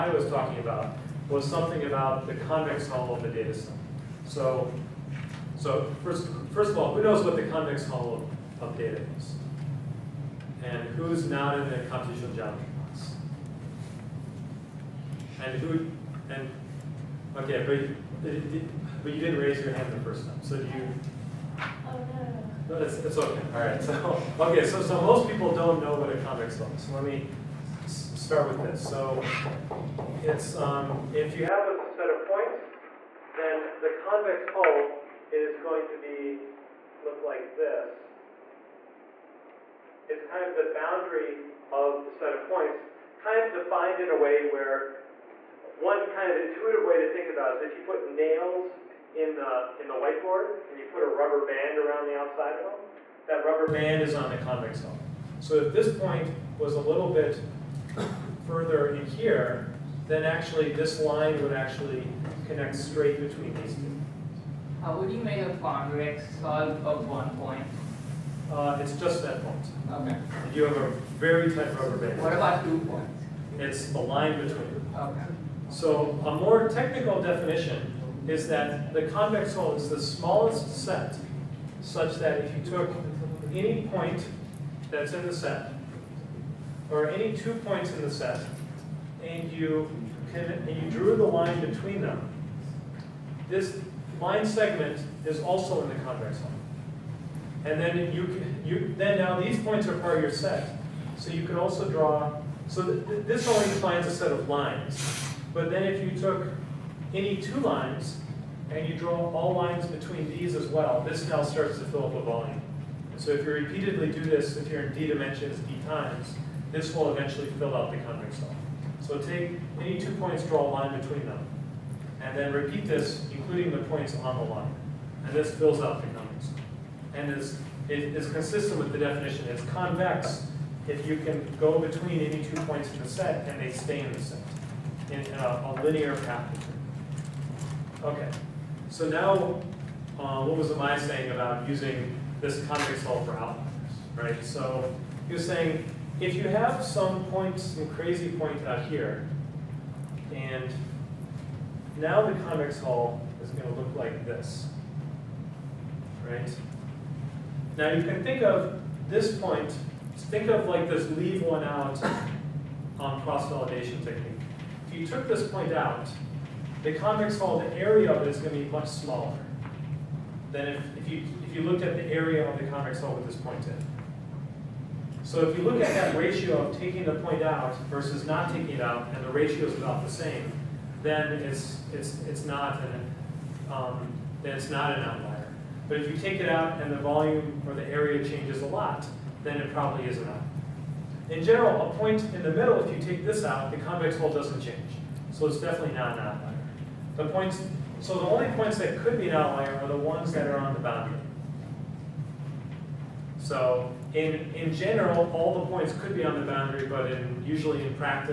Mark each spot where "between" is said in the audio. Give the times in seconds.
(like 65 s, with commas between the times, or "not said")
63 s, 74 s, 91 s, 109 s, 120 s, 131 s.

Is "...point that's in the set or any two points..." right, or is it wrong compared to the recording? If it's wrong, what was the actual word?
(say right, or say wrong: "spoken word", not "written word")
right.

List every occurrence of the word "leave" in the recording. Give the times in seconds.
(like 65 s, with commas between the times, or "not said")
161 s.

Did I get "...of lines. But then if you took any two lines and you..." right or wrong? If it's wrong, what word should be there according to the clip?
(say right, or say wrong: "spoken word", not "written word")
right.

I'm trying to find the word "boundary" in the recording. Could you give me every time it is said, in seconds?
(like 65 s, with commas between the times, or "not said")
40 s, 200 s, 206 s.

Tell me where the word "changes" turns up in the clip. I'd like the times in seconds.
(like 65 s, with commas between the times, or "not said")
188 s, 194 s.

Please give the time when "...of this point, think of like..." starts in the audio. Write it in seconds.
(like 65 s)
158 s.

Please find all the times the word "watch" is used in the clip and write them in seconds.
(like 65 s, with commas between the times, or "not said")
not said.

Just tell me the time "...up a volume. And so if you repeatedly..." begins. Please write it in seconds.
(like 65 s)
112 s.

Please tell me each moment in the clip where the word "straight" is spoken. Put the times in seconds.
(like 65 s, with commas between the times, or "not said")
62 s.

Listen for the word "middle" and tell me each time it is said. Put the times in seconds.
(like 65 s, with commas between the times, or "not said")
192 s.